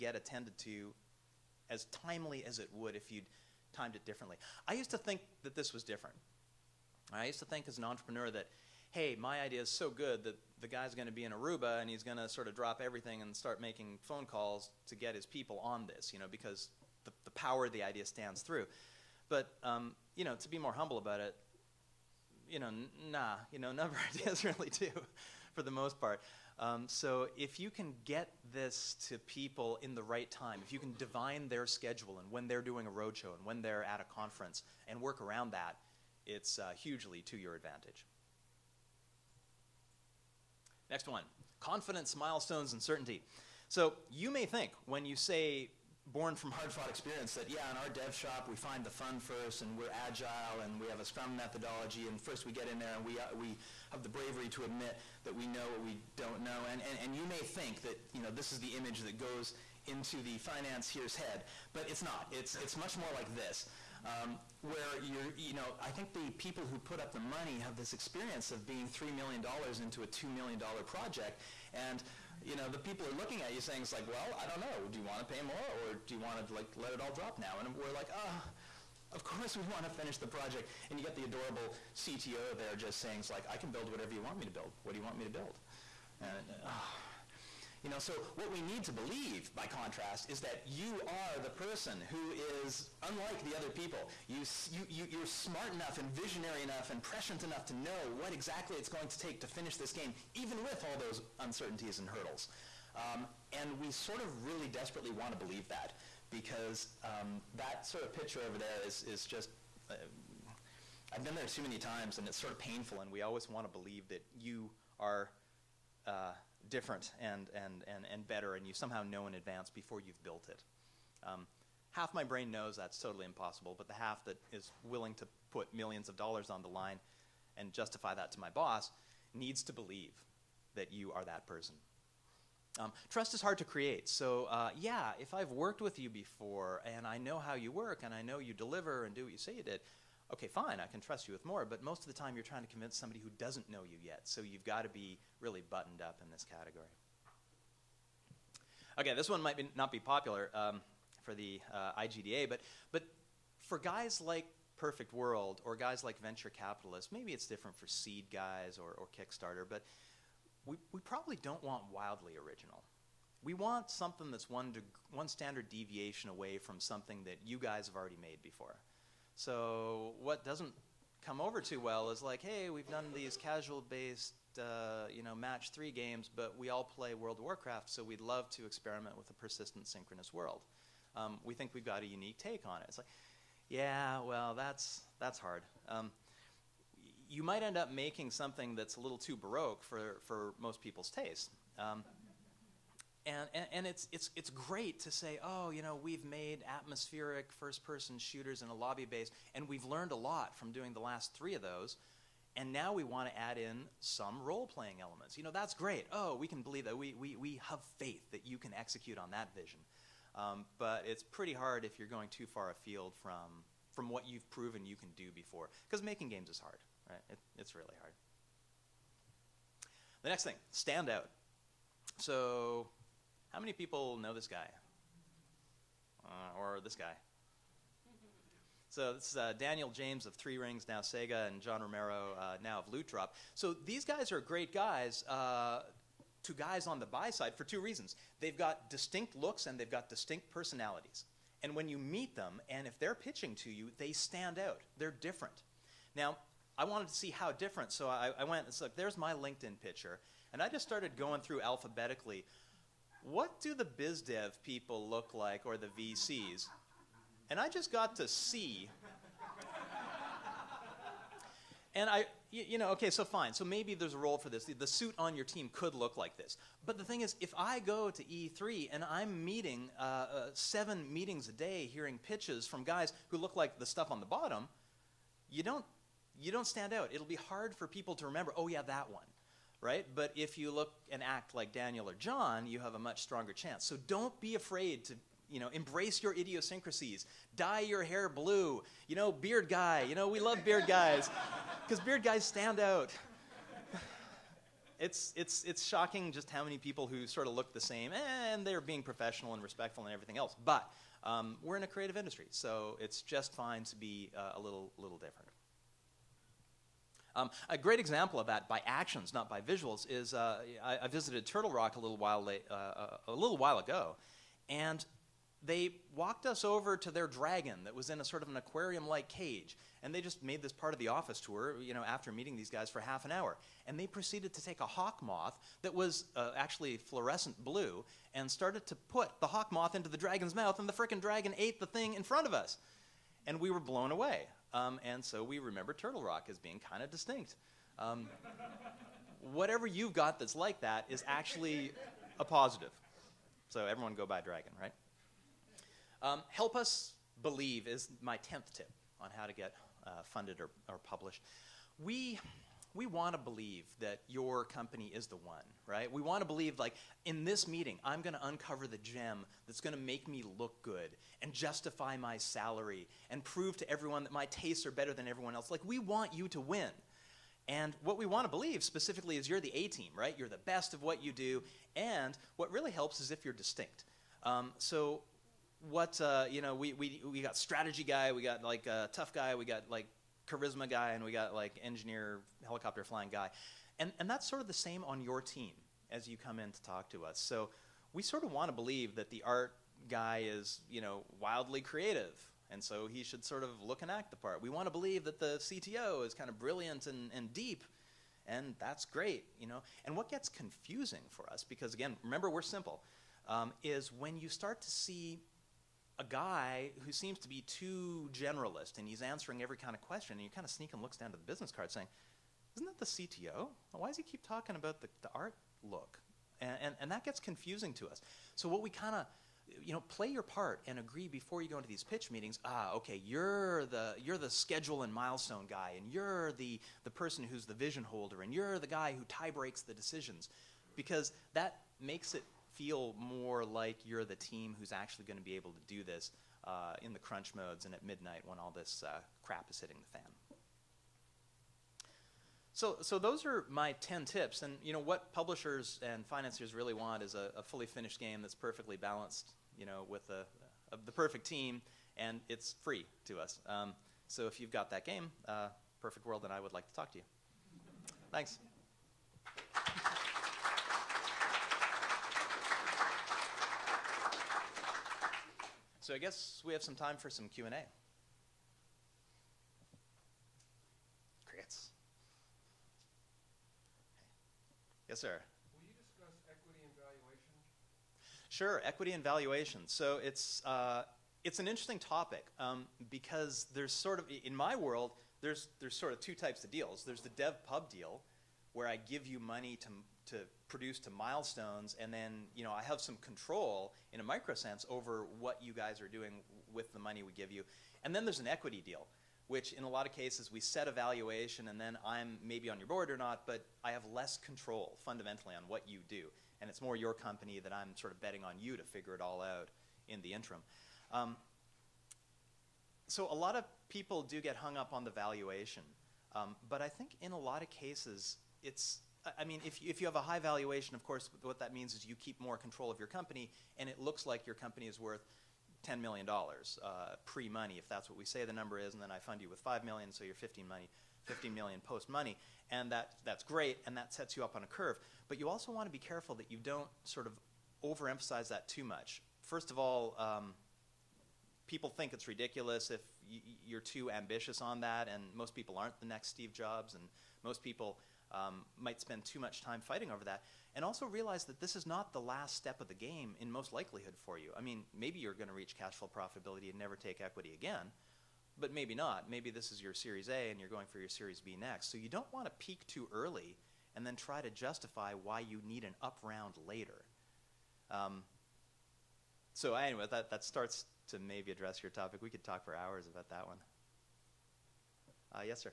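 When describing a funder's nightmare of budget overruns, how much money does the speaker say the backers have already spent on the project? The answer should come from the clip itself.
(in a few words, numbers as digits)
$3 million.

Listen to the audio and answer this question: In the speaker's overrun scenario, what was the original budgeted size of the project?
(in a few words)
$2 million.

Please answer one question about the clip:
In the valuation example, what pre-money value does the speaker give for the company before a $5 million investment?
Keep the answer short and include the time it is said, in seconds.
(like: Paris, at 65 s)
$10 million, at 525 s.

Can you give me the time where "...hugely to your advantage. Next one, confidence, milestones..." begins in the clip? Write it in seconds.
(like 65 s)
36 s.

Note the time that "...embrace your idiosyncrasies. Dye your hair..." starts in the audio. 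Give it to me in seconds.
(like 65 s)
285 s.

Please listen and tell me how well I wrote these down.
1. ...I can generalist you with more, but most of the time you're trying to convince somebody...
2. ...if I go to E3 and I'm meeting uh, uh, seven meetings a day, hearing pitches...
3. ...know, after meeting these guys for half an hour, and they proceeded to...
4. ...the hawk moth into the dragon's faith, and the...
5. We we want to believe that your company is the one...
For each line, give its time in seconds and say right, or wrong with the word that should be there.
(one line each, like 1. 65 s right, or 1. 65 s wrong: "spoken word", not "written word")
1. 140 s wrong: "trust", not "generalist"
2. 267 s right
3. 321 s right
4. 329 s wrong: "mouth", not "faith"
5. 351 s right.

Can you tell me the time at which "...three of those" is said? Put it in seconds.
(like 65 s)
201 s.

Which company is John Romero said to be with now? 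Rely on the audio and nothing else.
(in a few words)
Loot Drop.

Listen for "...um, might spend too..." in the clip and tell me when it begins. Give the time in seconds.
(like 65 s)
548 s.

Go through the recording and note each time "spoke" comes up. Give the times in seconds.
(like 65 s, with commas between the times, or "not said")
not said.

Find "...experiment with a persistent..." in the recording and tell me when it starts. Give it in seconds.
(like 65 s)
178 s.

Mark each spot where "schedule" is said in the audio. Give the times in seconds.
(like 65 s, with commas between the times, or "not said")
31 s, 424 s.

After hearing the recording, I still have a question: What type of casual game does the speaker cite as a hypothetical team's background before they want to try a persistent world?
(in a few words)
match three.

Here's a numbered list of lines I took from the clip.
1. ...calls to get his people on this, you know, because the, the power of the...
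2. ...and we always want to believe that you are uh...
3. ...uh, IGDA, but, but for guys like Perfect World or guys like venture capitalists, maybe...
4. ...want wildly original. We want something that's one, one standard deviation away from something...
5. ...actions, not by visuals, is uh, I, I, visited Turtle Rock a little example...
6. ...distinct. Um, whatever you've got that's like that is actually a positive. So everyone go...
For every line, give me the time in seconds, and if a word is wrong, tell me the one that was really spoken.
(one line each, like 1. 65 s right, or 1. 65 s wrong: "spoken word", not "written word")
1. 14 s right
2. 112 s right
3. 151 s right
4. 161 s right
5. 308 s wrong: "while", not "example"
6. 337 s right.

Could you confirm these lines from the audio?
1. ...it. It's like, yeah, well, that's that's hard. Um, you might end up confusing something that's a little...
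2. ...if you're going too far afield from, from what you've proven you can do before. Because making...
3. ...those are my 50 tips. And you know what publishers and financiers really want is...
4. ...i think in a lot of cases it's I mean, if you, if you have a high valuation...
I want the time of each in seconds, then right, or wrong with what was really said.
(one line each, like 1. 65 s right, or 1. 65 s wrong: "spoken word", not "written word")
1. 182 s wrong: "making", not "confusing"
2. 211 s right
3. 443 s wrong: "10", not "50"
4. 516 s right.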